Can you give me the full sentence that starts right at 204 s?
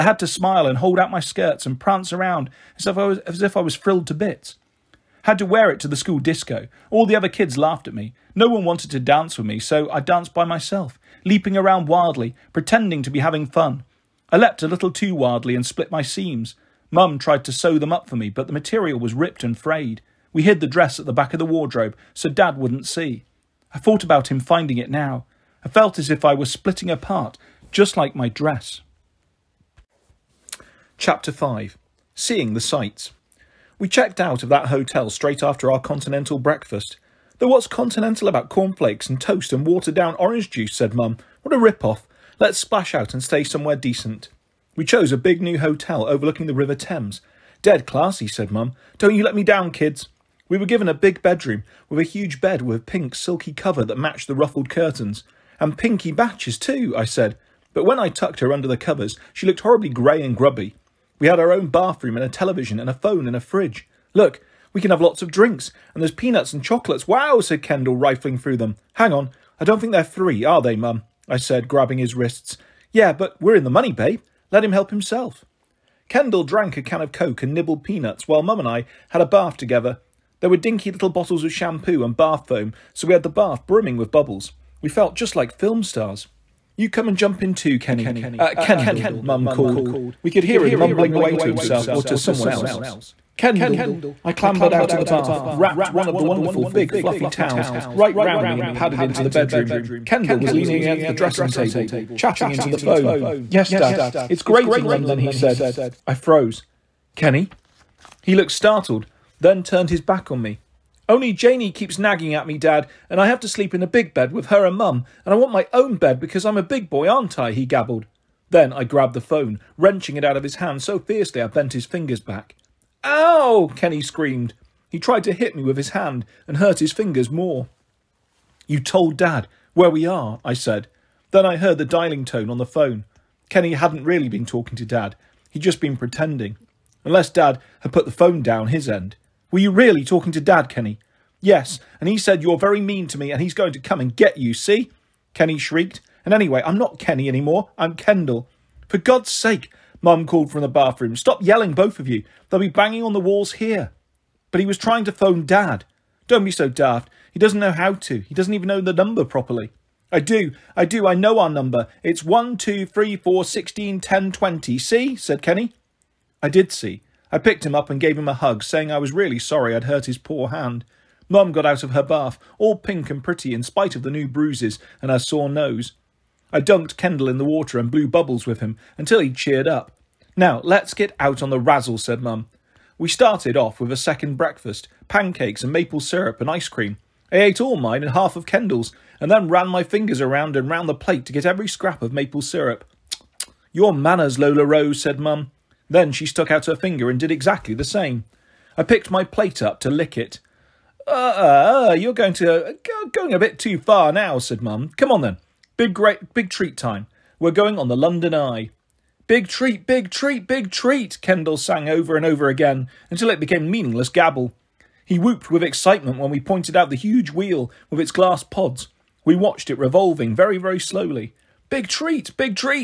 Come on then, Big great big treat time.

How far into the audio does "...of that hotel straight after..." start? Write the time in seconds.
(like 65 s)
34 s.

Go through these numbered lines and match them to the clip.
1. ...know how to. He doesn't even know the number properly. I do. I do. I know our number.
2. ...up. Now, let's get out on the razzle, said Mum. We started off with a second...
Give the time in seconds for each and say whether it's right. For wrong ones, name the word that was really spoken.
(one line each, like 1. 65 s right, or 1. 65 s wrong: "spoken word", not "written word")
1. 157 s right
2. 179 s right.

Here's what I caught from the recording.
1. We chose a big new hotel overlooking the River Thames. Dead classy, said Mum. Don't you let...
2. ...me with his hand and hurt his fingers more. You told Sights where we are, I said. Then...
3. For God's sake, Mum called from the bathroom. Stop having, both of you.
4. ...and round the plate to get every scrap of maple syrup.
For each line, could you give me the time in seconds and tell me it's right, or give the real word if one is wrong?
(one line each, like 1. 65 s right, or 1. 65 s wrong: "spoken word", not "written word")
1. 44 s right
2. 125 s wrong: "Dad", not "Sights"
3. 148 s wrong: "yelling", not "having"
4. 190 s right.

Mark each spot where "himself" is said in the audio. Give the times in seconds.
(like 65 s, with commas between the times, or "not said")
74 s, 91 s.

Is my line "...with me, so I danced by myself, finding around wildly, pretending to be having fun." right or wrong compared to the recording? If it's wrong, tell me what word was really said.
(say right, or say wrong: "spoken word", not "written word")
wrong: "leaping", not "finding".